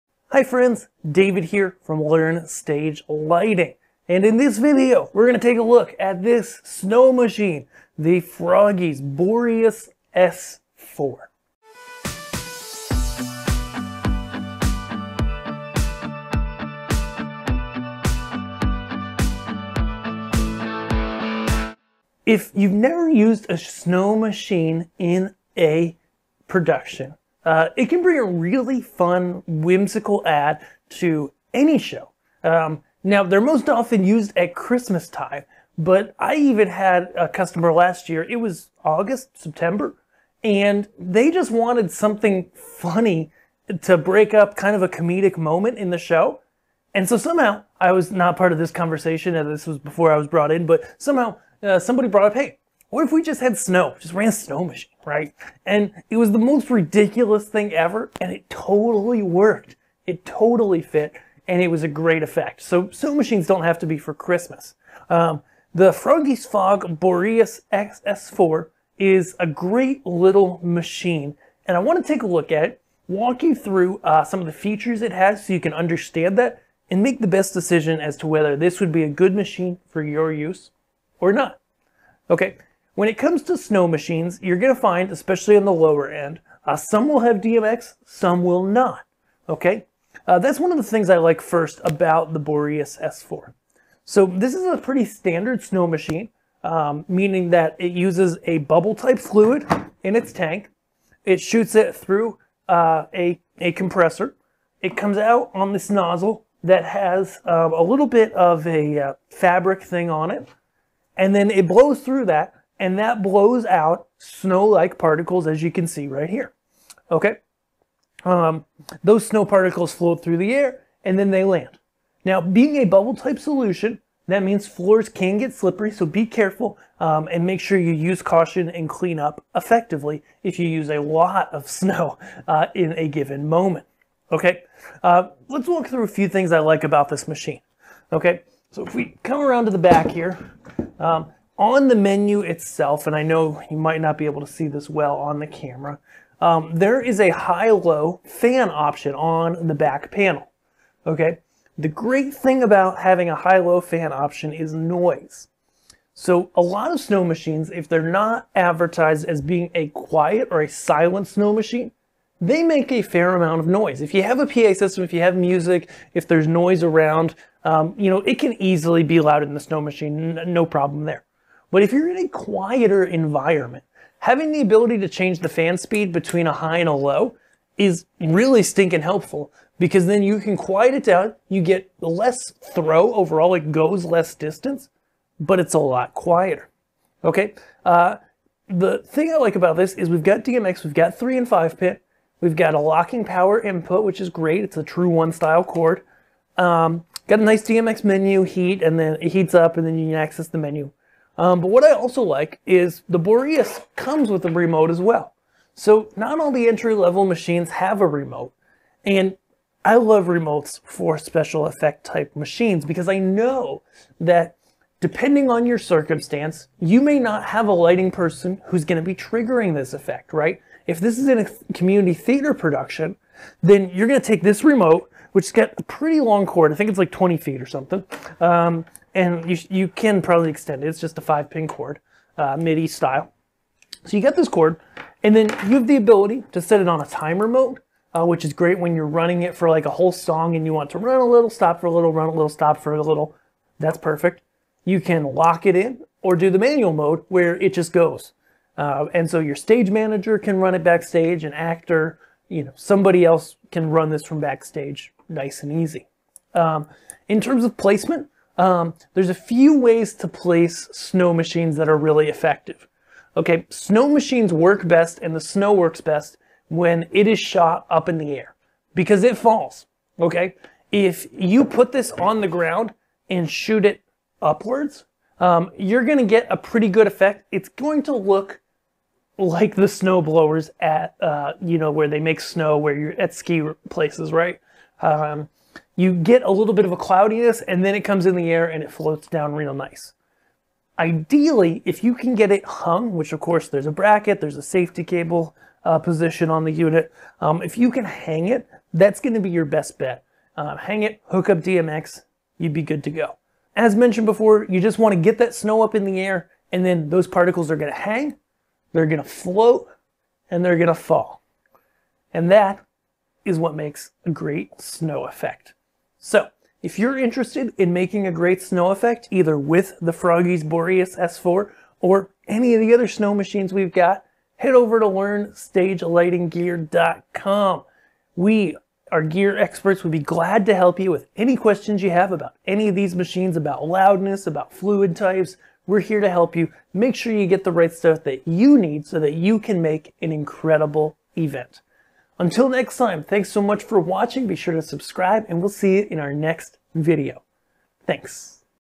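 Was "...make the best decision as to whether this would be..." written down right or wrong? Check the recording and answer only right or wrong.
right.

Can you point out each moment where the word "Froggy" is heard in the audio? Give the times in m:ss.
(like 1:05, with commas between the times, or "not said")
0:08, 1:05, 5:20.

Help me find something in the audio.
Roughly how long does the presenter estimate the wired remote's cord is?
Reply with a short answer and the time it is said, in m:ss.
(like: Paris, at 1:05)
20 feet, at 3:47.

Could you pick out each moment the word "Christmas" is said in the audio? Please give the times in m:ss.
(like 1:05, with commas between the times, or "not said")
0:34, 1:04.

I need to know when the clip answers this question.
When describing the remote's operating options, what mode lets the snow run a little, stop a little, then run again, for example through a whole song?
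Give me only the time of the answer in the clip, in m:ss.
3:57.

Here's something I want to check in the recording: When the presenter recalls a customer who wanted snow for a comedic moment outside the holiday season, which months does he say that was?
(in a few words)
August, September.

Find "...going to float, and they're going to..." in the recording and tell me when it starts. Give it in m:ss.
5:09.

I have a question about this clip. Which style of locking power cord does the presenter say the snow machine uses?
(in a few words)
TRUE1.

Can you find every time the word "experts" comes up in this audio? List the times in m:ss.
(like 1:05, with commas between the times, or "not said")
5:29.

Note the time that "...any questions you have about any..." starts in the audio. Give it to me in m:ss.
5:31.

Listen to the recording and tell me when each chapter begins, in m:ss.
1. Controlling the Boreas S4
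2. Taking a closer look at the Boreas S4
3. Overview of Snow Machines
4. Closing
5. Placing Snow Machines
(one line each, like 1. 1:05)
1. 3:21
2. 2:28
3. 1:22
4. 5:00
5. 4:19.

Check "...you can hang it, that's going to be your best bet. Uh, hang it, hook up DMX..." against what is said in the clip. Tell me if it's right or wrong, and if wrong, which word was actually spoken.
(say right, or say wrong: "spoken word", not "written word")
right.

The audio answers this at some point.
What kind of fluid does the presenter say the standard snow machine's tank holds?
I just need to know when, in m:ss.
1:38.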